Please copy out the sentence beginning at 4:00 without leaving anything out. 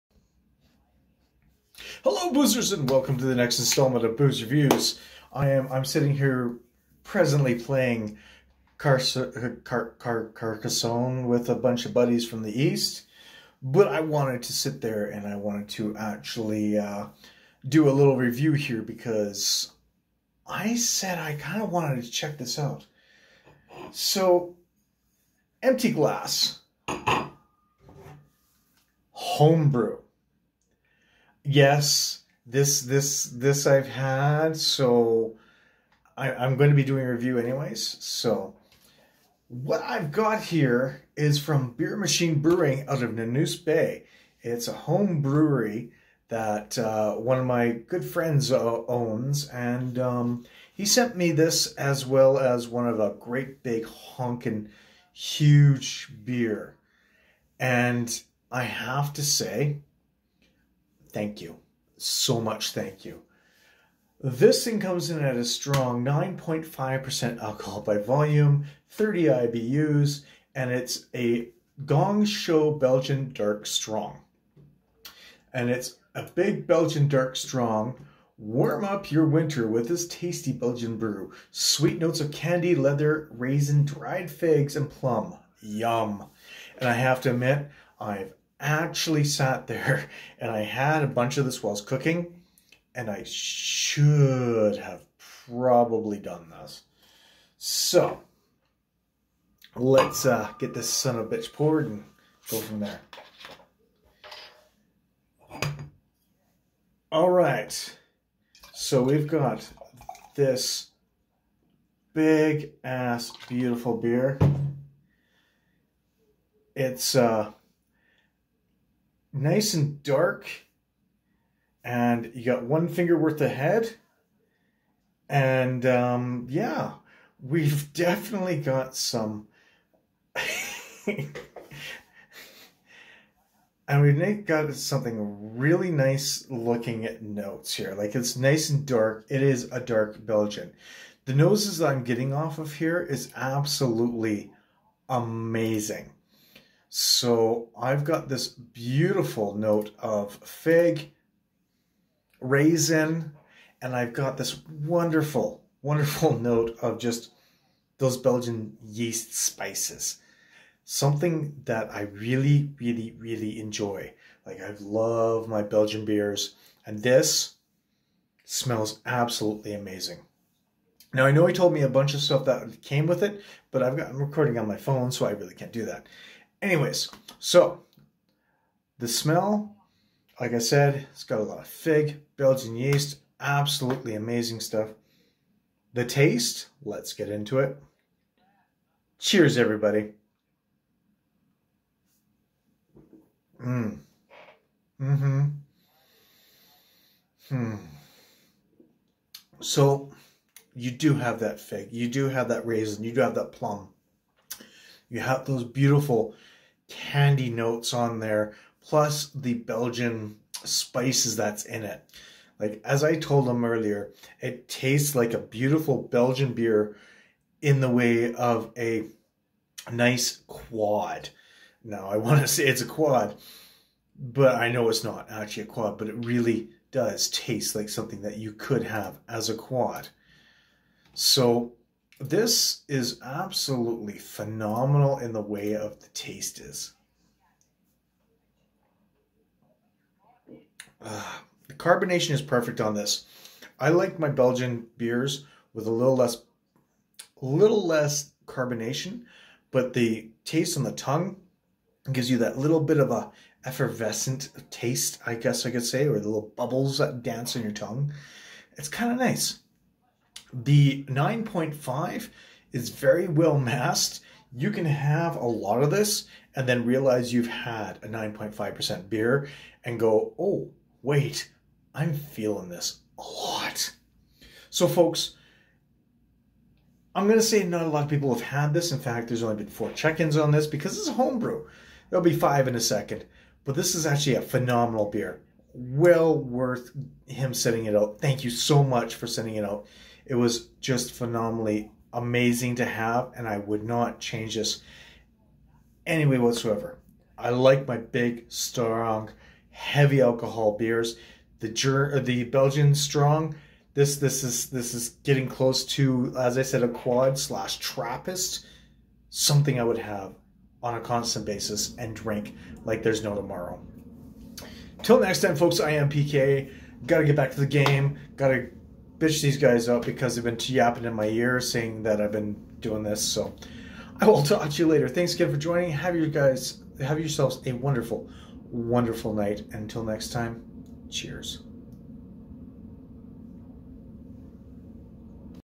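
Uh, ah, the carbonation is perfect on this.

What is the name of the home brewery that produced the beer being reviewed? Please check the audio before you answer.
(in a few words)
Beer Machine Brewing.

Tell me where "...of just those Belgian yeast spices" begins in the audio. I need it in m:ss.
2:36.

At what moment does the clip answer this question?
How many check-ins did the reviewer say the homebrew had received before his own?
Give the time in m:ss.
4:39.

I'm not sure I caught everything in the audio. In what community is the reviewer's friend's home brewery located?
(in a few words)
Nanoose Bay.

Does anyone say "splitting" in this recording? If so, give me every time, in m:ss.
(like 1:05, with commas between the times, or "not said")
not said.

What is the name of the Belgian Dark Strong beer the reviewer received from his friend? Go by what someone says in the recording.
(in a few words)
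Gong Show.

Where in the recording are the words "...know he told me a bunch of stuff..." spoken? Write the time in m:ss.
2:51.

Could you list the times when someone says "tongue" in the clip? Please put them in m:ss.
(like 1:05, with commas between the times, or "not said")
4:10, 4:17.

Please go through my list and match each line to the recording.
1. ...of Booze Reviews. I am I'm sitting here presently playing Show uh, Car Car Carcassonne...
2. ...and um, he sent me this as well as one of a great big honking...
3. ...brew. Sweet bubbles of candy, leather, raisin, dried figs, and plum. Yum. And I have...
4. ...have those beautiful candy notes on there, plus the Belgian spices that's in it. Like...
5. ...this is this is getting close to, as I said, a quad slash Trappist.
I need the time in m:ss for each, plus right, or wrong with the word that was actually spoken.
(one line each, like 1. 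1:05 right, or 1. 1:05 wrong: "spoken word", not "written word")
1. 0:04 wrong: "Car", not "Show"
2. 0:49 right
3. 1:20 wrong: "notes", not "bubbles"
4. 3:25 right
5. 5:04 right.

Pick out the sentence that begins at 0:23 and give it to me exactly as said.
So, empty glass, homebrew yes, this this this I've had, so I, I'm going to be doing a review anyways.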